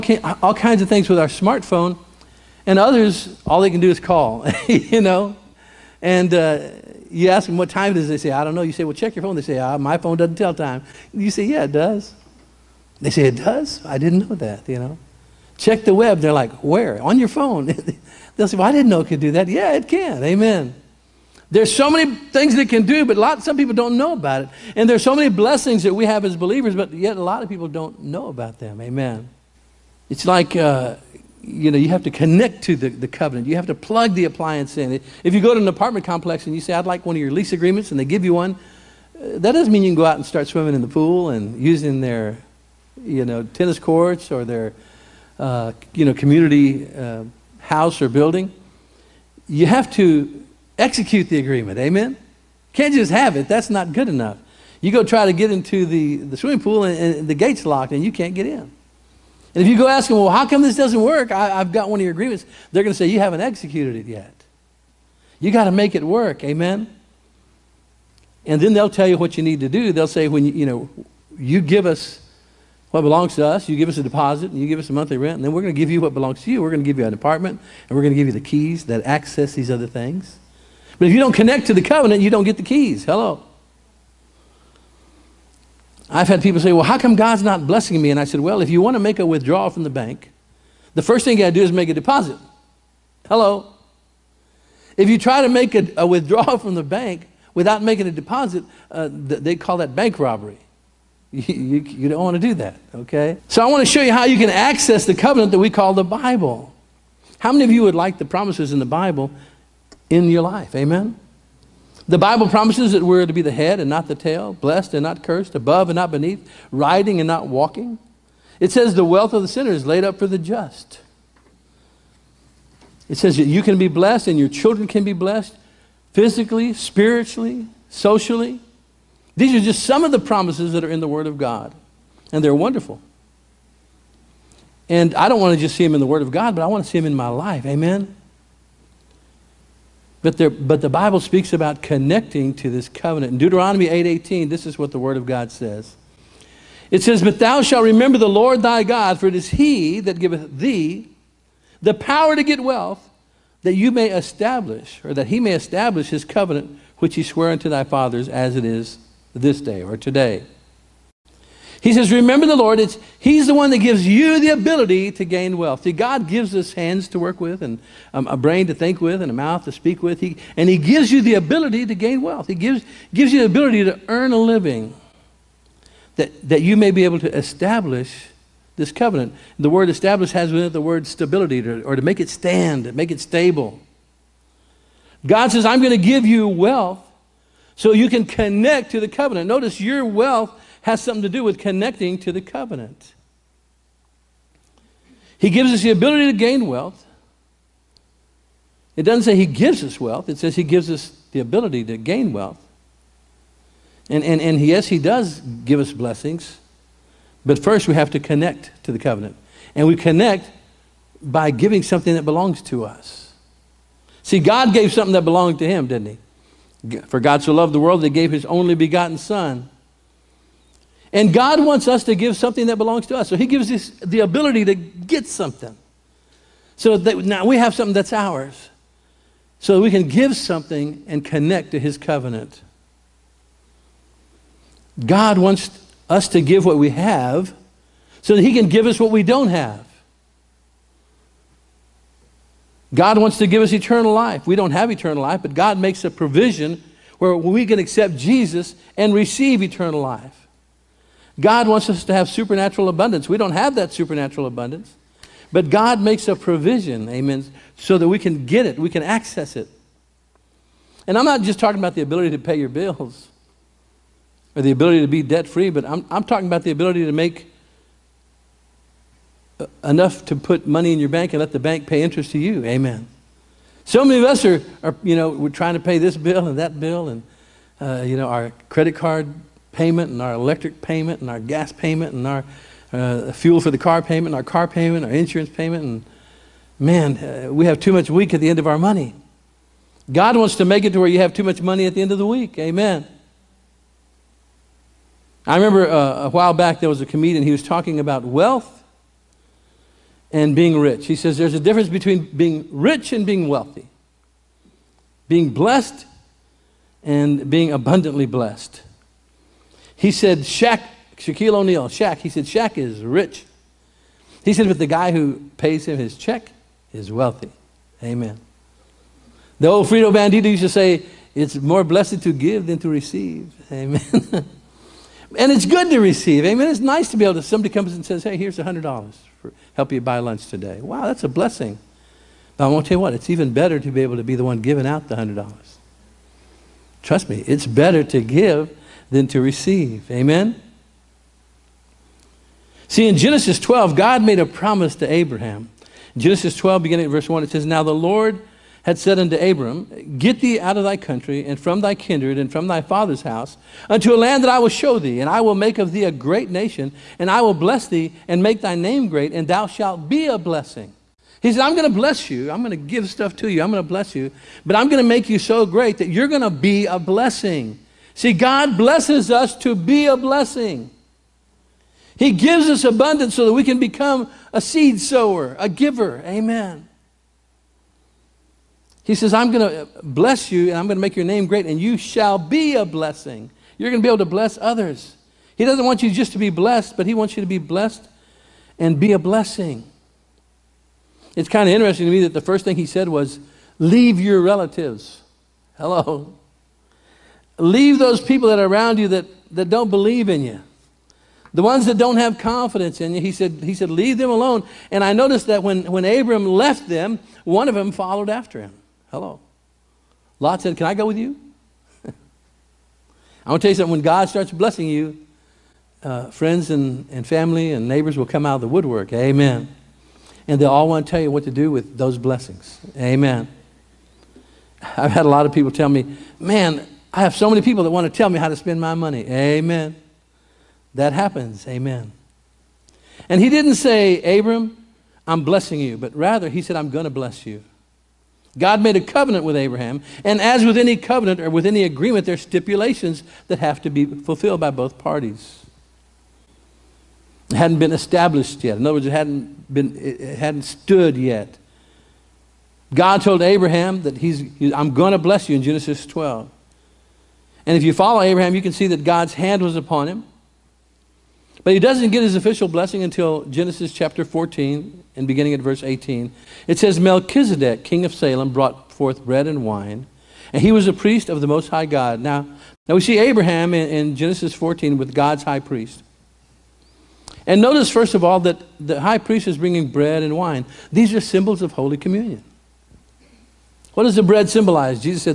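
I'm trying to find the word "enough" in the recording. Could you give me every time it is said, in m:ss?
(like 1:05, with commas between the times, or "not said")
0:54, 4:29.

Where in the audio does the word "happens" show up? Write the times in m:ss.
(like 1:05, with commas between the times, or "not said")
7:11.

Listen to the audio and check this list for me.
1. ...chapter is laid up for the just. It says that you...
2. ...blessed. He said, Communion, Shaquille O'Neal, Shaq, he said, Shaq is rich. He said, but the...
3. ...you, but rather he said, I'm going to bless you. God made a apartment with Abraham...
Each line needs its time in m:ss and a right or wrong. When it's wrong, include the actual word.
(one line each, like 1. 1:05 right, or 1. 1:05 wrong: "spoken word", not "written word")
1. 1:59 wrong: "sinner", not "chapter"
2. 5:08 wrong: "Shaq", not "Communion"
3. 7:15 wrong: "covenant", not "apartment".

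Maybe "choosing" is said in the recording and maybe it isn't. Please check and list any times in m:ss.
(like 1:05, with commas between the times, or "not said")
not said.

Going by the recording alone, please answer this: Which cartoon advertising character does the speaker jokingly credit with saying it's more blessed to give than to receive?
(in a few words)
Frito Bandito.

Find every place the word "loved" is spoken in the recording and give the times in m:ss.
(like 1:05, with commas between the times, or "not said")
3:37.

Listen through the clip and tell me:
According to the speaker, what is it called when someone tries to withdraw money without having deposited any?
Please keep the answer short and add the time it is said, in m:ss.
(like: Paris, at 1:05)
bank robbery, at 1:39.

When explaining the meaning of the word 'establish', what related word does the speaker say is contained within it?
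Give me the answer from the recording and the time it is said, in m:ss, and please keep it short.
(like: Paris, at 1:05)
stability, at 3:01.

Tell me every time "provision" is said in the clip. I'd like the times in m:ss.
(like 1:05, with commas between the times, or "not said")
4:06, 4:16.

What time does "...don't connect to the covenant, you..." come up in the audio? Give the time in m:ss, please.
1:21.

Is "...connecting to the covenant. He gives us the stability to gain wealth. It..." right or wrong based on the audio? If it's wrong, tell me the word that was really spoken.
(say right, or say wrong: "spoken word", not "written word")
wrong: "ability", not "stability".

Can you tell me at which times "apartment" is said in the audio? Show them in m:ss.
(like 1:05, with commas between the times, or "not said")
0:35, 1:17.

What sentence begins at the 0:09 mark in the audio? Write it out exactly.
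They say, ah, my phone doesn't tell time.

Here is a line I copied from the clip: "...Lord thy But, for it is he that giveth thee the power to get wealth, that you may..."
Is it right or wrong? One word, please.
wrong.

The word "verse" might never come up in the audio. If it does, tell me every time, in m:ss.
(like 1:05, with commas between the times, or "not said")
5:47, 7:45.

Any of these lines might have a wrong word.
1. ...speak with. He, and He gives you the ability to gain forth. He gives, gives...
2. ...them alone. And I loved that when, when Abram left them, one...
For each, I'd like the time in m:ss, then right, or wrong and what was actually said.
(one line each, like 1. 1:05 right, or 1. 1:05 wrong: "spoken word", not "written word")
1. 2:49 wrong: "wealth", not "forth"
2. 6:44 wrong: "noticed", not "loved".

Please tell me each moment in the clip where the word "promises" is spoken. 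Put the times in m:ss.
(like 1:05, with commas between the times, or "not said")
1:48, 1:52, 2:10, 5:44.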